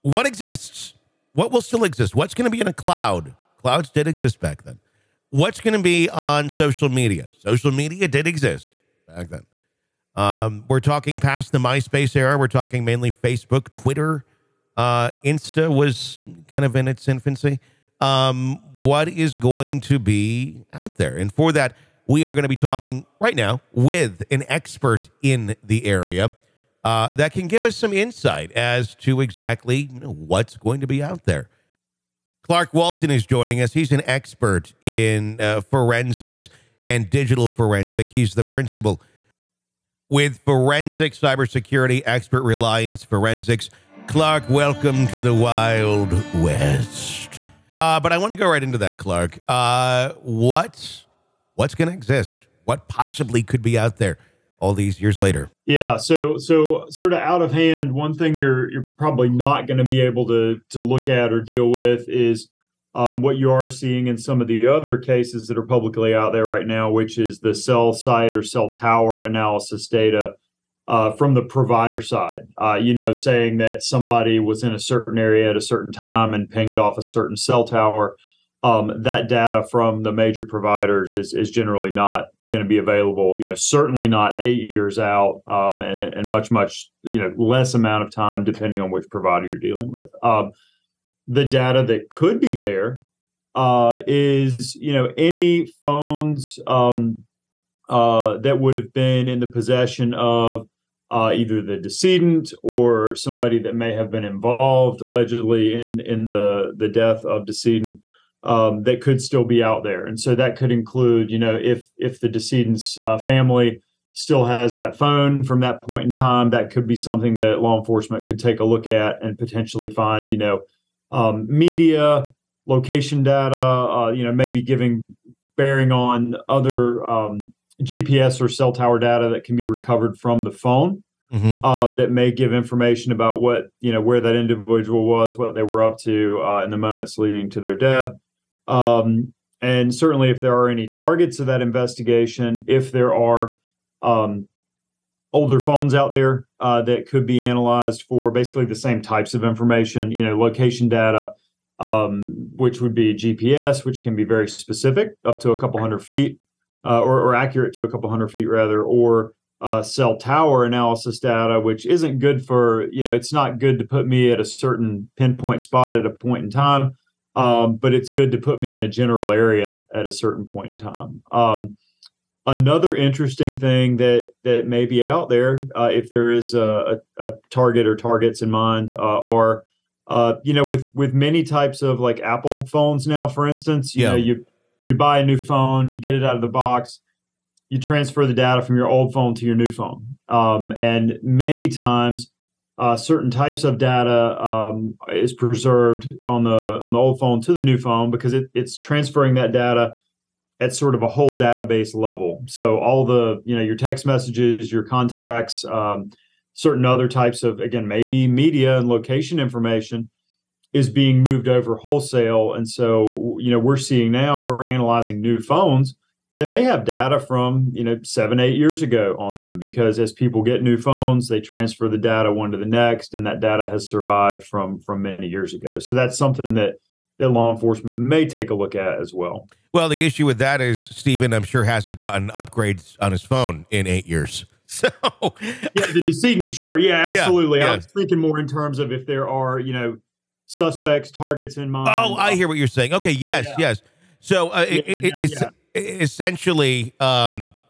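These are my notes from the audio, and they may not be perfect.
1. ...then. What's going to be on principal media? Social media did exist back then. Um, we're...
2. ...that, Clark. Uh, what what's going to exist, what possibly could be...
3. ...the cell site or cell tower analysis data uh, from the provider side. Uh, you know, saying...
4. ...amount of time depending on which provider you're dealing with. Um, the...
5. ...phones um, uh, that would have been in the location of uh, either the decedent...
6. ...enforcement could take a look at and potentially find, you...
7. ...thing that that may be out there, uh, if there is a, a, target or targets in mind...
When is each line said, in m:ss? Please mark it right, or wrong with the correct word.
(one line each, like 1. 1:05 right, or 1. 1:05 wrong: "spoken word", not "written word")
1. 0:04 wrong: "social", not "principal"
2. 0:48 right
3. 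1:07 right
4. 1:27 right
5. 1:35 wrong: "possession", not "location"
6. 1:57 right
7. 2:53 right.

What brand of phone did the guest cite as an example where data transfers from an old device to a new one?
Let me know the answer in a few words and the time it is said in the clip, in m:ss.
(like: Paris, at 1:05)
Apple, at 3:02.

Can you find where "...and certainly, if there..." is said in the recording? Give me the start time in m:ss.
2:19.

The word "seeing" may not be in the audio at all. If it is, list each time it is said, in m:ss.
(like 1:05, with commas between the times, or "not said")
1:03, 3:33.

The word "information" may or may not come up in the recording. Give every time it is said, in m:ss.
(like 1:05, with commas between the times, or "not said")
2:12, 2:29, 3:29.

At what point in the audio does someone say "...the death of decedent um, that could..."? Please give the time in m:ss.
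1:46.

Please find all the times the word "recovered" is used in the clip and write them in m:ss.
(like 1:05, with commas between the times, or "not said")
2:09.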